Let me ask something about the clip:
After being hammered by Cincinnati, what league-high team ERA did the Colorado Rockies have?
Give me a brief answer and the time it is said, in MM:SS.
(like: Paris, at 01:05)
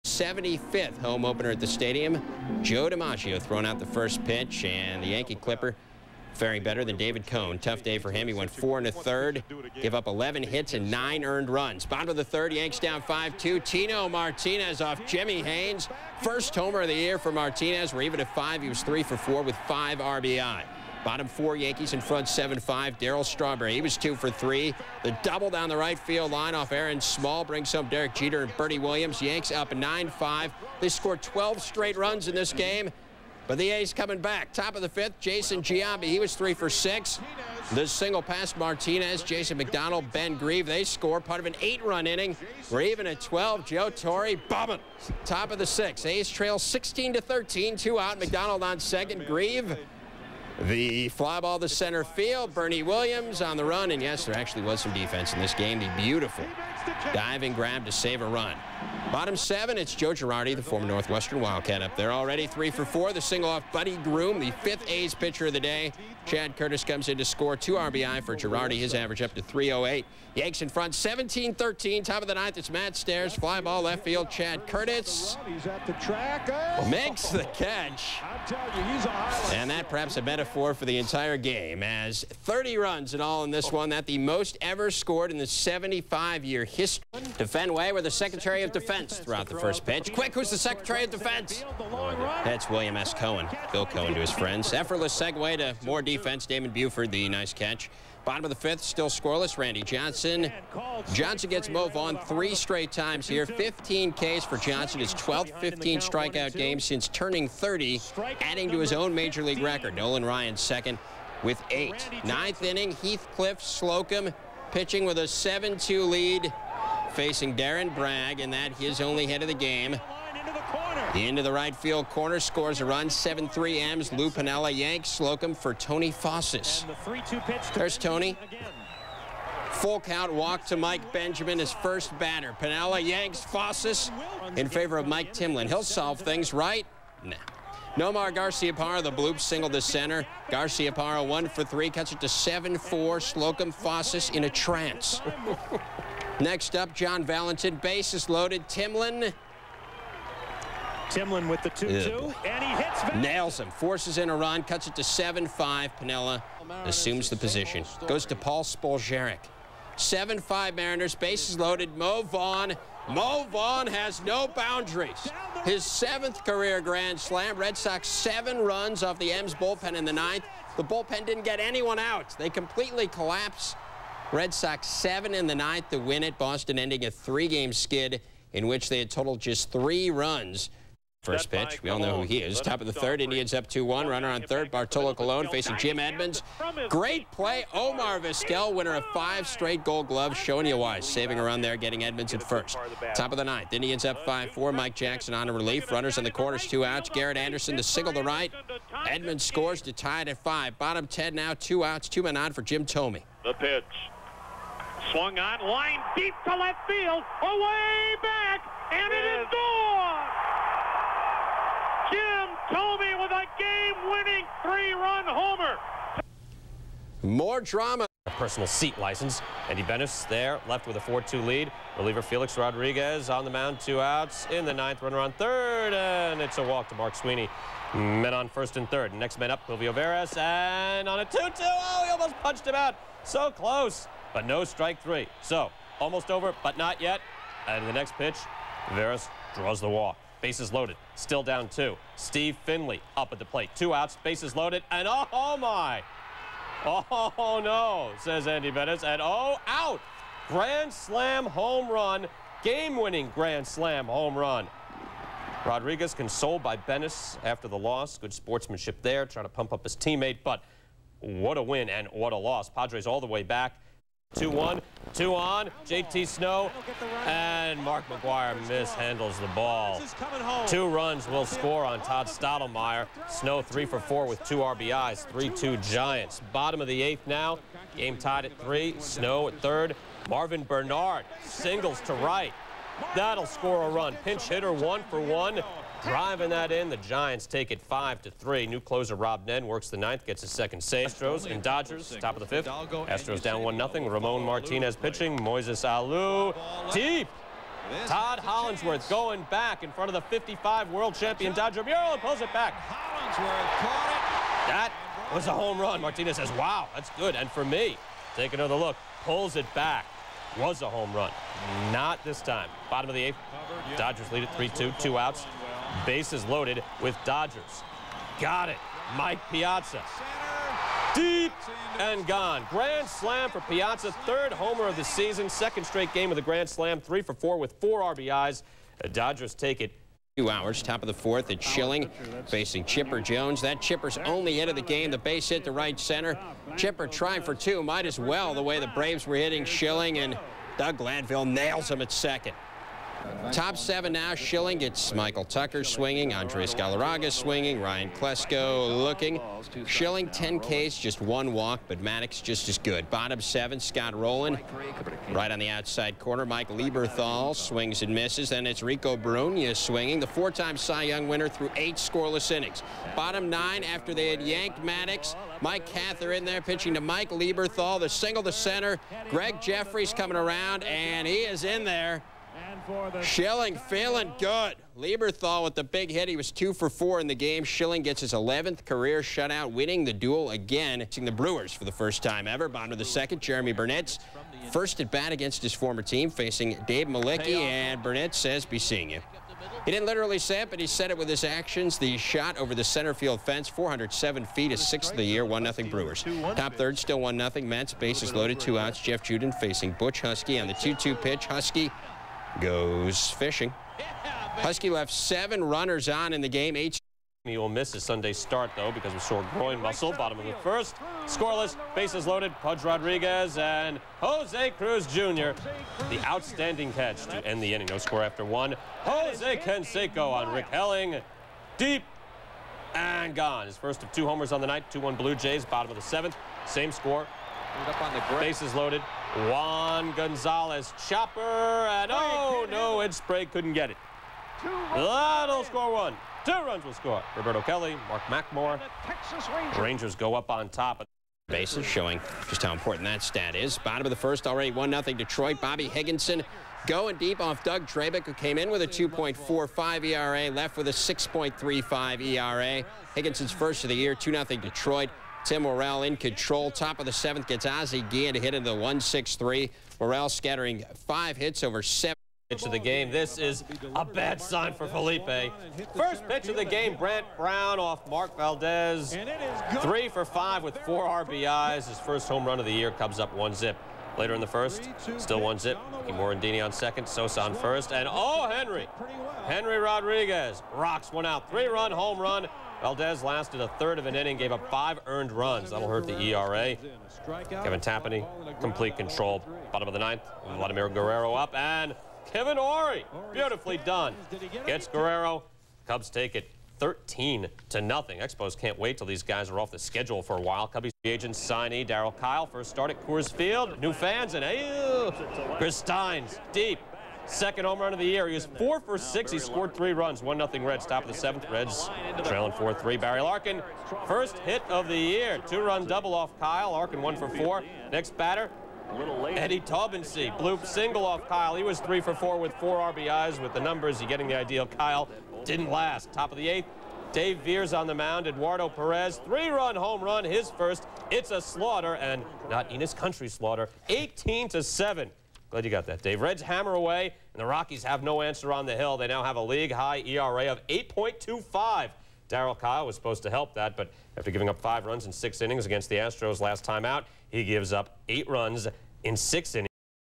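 8.25, at 09:00.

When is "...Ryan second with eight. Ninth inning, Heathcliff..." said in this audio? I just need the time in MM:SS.
01:50.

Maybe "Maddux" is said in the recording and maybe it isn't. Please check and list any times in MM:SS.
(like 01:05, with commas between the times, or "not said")
05:52, 06:04.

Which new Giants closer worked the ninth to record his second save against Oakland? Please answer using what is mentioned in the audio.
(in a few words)
Rob Nen.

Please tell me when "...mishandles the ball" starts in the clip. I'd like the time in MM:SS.
04:28.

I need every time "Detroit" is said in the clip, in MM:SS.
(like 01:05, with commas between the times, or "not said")
07:25, 07:34.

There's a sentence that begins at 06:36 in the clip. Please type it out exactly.
Top third, still 1 0 Mets.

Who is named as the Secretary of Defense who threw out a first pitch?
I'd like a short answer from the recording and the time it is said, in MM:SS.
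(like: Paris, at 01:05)
William S. Cohen, at 01:32.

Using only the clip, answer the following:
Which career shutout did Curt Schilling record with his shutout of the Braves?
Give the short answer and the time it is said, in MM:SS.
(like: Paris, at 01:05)
11th, at 06:18.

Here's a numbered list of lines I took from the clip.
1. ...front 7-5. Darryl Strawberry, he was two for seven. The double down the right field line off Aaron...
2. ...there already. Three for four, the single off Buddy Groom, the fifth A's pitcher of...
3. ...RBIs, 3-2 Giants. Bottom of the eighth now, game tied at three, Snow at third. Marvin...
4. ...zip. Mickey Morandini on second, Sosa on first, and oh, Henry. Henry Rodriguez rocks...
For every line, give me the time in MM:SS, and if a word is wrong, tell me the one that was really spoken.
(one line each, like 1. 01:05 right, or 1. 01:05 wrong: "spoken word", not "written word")
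1. 00:22 wrong: "three", not "seven"
2. 01:01 right
3. 04:34 right
4. 07:55 right.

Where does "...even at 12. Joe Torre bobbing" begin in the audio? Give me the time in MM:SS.
00:42.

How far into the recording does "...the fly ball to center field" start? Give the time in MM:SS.
00:50.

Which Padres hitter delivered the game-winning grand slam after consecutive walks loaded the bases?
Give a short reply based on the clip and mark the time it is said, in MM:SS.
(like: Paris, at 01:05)
Steve Finley, at 04:02.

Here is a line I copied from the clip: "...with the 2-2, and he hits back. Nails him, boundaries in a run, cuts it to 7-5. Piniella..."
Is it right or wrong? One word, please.
wrong.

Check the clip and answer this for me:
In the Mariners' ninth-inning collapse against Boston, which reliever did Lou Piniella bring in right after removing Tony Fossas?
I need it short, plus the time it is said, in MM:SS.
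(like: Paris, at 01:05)
Mike Timlin, at 02:15.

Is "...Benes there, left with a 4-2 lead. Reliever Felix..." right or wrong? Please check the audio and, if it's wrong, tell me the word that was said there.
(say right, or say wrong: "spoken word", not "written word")
right.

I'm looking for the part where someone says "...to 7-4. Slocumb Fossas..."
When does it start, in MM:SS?
02:22.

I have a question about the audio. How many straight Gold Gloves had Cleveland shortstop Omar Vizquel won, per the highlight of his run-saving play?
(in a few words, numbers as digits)
5.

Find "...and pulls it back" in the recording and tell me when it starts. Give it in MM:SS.
05:02.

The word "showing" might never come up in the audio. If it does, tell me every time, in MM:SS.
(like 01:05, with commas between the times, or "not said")
03:10, 07:21.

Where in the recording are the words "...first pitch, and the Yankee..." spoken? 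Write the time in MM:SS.
00:03.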